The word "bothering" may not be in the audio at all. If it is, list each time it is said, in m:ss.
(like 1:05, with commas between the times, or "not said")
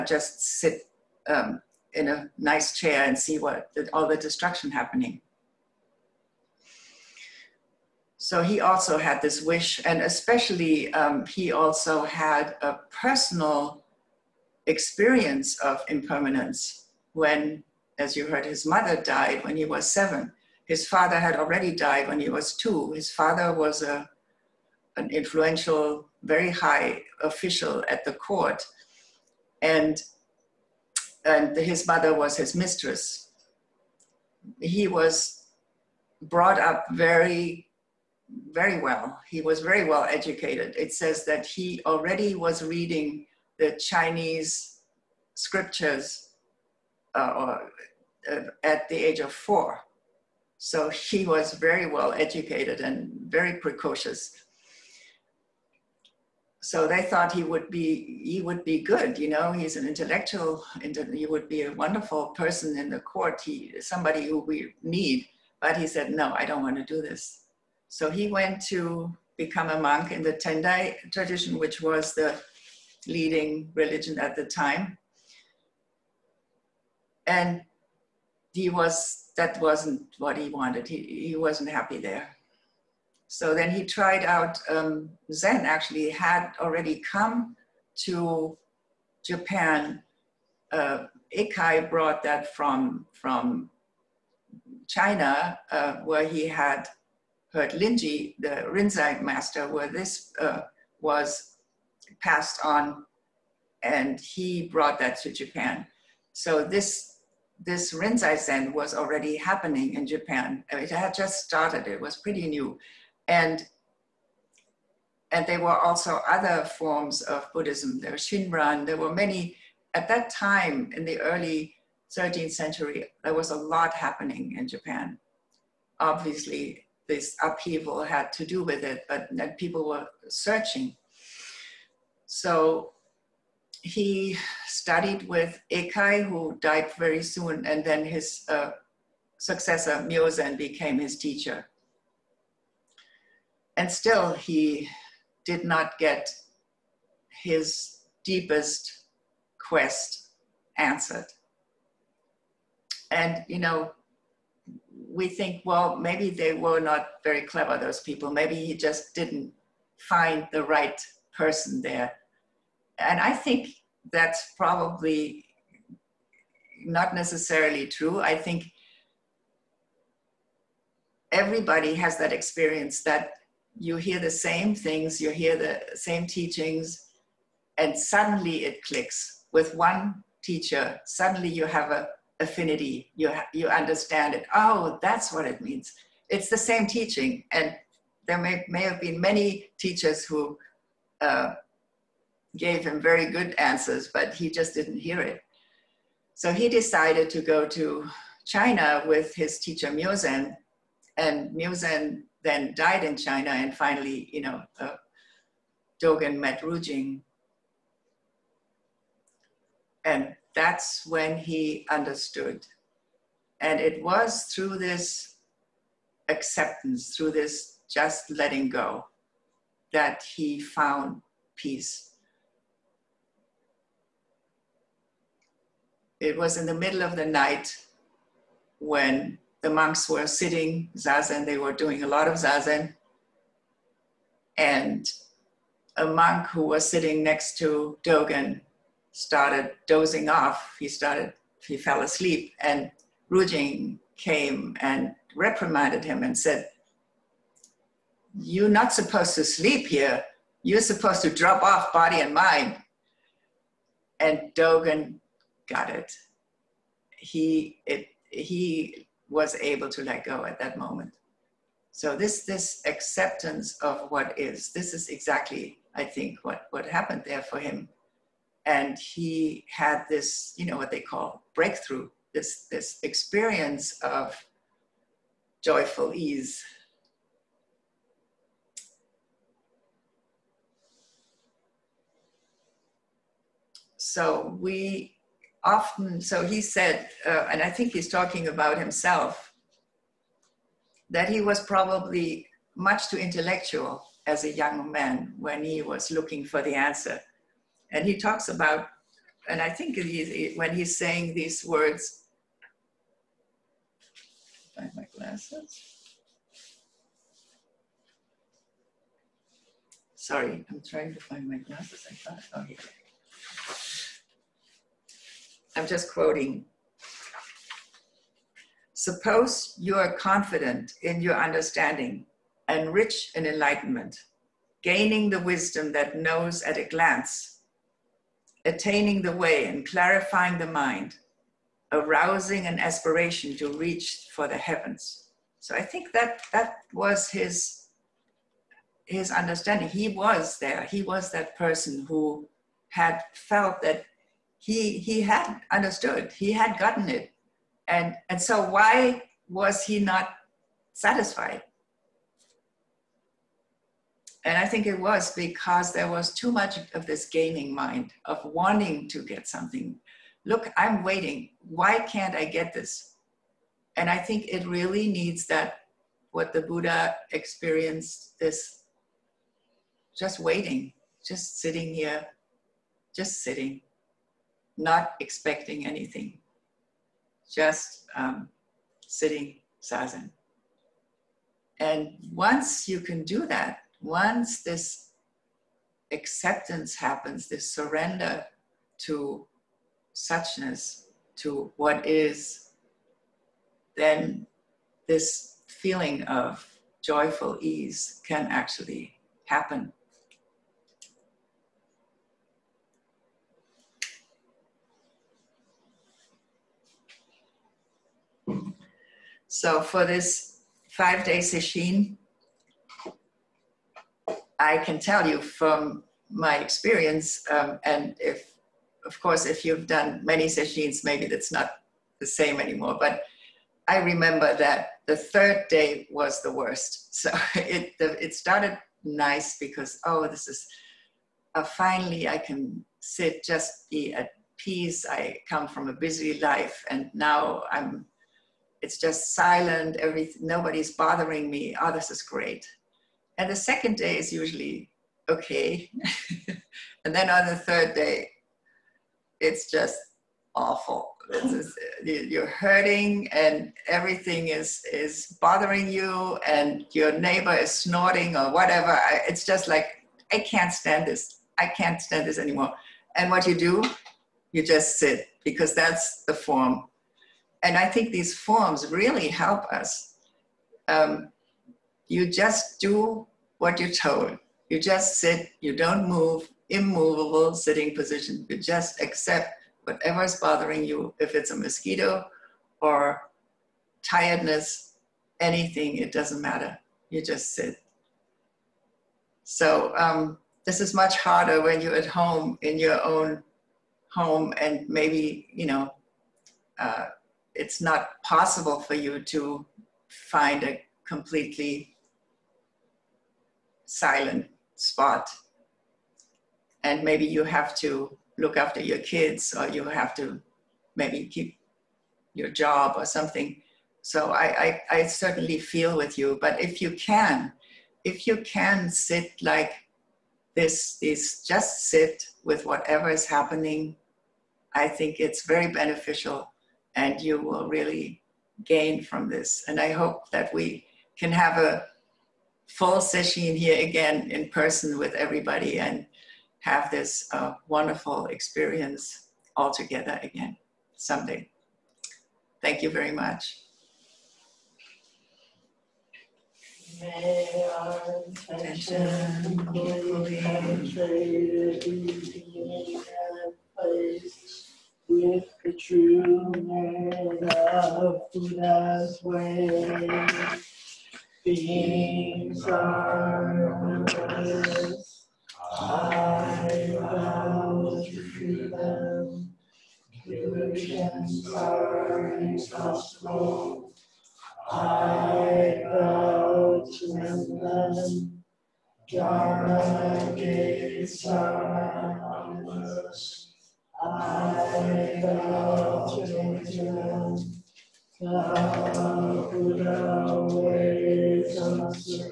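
7:20, 7:35, 8:00.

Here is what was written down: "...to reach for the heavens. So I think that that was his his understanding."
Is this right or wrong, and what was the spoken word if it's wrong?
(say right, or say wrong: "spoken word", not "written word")
right.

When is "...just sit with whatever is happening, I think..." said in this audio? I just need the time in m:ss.
8:41.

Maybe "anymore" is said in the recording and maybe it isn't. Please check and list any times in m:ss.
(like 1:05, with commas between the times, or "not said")
7:02, 7:42.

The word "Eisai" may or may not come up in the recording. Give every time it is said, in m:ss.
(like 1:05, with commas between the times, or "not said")
1:31, 2:15.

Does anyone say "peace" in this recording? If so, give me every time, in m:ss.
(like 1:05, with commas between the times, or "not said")
3:41, 7:14.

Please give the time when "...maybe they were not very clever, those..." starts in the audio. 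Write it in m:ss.
2:35.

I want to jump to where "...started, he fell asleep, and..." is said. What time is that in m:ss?
4:00.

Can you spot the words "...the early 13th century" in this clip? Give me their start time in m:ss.
2:01.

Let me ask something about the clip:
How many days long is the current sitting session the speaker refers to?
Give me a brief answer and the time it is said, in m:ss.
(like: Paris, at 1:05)
5, at 6:50.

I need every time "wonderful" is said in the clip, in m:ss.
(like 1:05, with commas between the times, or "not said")
1:01, 8:57.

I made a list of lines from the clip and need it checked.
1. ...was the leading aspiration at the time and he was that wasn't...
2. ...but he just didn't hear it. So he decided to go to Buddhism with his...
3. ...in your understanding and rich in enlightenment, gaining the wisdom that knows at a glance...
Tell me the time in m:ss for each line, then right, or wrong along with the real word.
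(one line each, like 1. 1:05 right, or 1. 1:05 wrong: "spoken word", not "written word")
1. 1:11 wrong: "religion", not "aspiration"
2. 3:14 wrong: "China", not "Buddhism"
3. 5:21 right.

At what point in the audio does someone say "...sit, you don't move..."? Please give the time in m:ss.
7:55.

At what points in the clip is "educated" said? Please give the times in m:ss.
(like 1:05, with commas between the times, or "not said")
0:40, 0:52.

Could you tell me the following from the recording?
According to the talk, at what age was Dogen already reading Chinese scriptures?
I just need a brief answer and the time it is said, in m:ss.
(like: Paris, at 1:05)
4, at 0:49.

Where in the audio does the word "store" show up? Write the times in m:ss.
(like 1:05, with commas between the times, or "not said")
not said.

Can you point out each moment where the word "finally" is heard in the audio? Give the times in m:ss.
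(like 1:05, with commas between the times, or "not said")
3:23, 7:11.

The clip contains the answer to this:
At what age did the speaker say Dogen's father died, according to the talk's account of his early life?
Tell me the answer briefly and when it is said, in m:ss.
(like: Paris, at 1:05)
2, at 0:22.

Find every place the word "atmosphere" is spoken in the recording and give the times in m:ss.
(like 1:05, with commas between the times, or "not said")
not said.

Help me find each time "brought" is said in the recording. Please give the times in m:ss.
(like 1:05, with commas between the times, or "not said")
0:36, 1:31, 1:44.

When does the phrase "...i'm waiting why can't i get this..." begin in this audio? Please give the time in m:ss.
6:00.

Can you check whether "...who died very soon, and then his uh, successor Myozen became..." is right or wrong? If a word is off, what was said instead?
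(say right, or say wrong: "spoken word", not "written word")
right.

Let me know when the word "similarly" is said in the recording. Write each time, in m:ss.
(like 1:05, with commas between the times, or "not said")
not said.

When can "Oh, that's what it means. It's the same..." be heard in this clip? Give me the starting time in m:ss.
3:04.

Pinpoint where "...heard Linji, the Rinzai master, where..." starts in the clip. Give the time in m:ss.
1:37.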